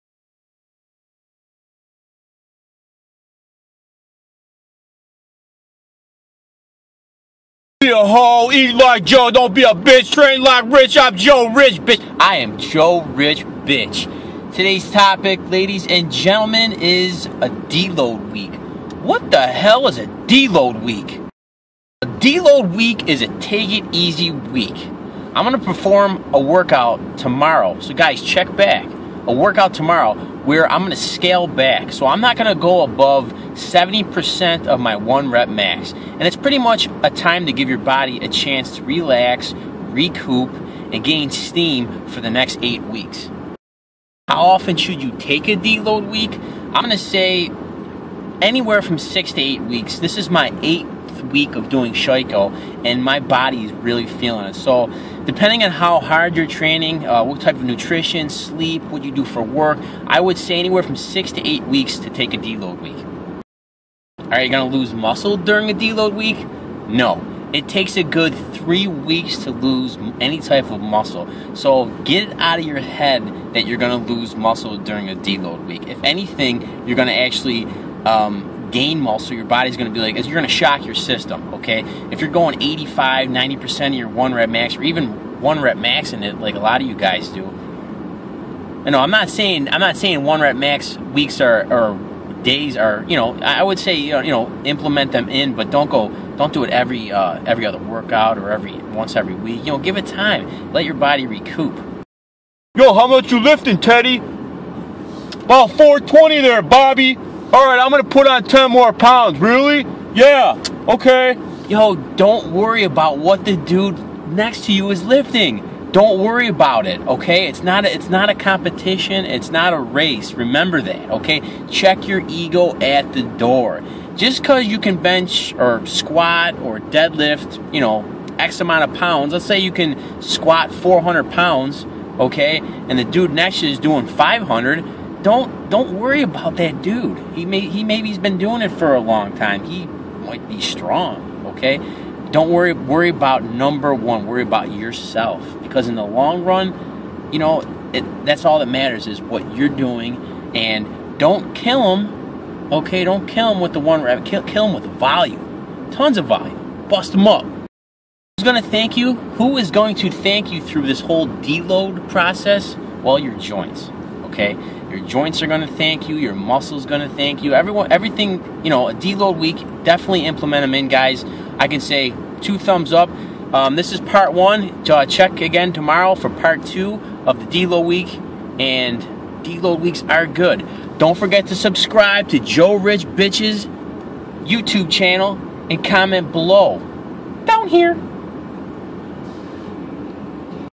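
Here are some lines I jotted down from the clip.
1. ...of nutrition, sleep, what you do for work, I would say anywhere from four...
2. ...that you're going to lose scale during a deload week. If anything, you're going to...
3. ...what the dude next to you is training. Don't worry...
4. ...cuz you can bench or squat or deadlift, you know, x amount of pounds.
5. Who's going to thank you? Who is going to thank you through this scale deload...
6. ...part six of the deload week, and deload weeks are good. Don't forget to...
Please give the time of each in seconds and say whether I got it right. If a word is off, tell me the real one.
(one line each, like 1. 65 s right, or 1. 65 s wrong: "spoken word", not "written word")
1. 57 s wrong: "six", not "four"
2. 73 s wrong: "muscle", not "scale"
3. 113 s wrong: "lifting", not "training"
4. 124 s right
5. 157 s wrong: "whole", not "scale"
6. 176 s wrong: "two", not "six".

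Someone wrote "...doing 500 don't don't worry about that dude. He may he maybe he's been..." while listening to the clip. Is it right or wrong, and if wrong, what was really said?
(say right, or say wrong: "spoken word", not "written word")
right.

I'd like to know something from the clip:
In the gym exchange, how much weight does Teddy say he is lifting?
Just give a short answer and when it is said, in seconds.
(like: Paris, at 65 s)
420, at 105 s.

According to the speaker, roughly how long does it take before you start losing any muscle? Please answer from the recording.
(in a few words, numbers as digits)
3 weeks.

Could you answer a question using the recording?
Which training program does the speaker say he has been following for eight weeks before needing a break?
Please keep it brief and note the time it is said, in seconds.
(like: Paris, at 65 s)
Sheiko, at 51 s.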